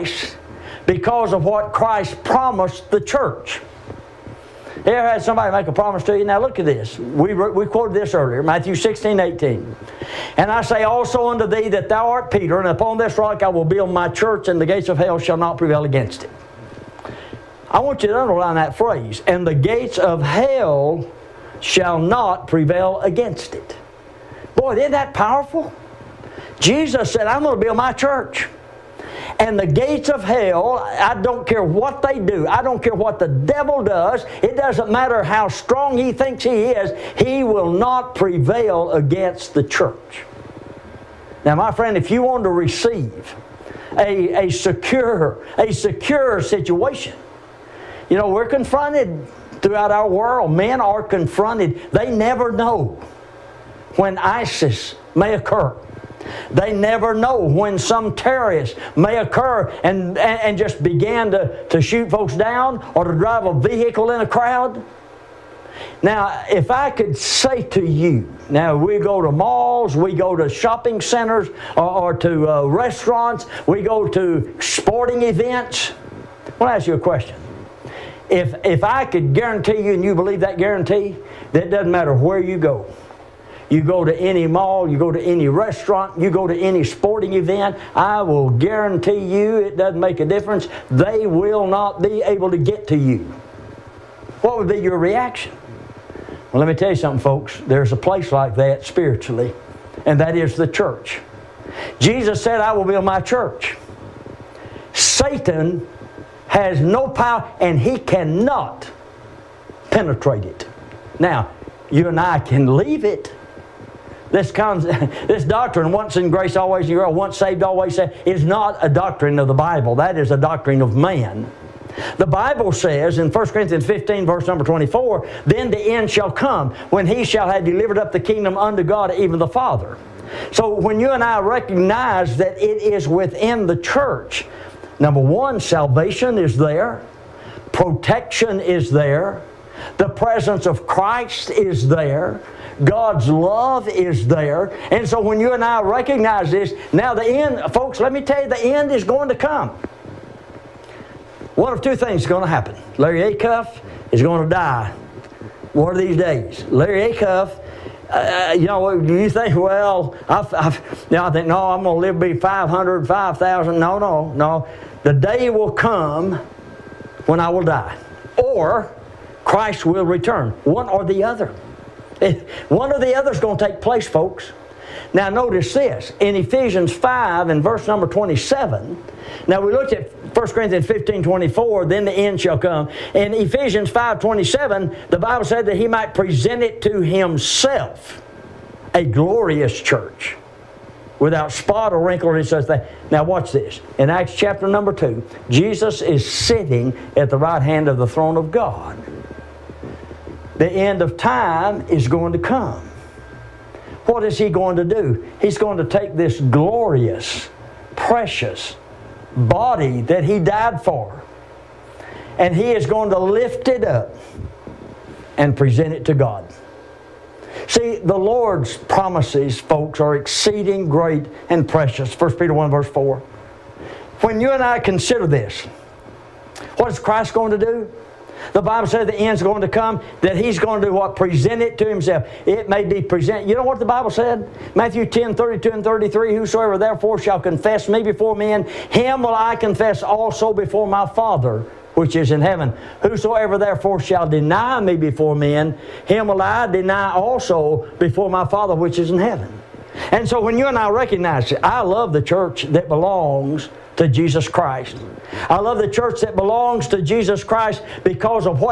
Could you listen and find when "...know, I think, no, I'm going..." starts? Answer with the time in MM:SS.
02:41.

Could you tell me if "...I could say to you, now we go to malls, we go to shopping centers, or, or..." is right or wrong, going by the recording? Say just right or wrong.
right.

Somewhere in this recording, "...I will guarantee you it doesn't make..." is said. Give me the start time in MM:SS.
01:27.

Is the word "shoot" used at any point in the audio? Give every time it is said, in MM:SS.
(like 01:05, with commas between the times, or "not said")
01:01.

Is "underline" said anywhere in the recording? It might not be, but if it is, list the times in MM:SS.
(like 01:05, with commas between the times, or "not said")
00:18.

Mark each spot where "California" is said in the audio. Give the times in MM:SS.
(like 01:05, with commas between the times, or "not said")
not said.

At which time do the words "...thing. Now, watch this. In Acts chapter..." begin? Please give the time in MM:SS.
03:12.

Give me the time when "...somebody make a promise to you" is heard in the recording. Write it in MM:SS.
00:05.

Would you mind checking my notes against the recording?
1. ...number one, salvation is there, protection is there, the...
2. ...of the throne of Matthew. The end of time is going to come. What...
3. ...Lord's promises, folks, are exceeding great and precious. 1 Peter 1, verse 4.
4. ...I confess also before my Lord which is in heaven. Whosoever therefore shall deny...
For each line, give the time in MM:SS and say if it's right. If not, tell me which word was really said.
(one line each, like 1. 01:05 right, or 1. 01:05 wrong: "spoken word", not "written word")
1. 02:15 right
2. 03:17 wrong: "God", not "Matthew"
3. 03:38 right
4. 03:59 wrong: "Father", not "Lord".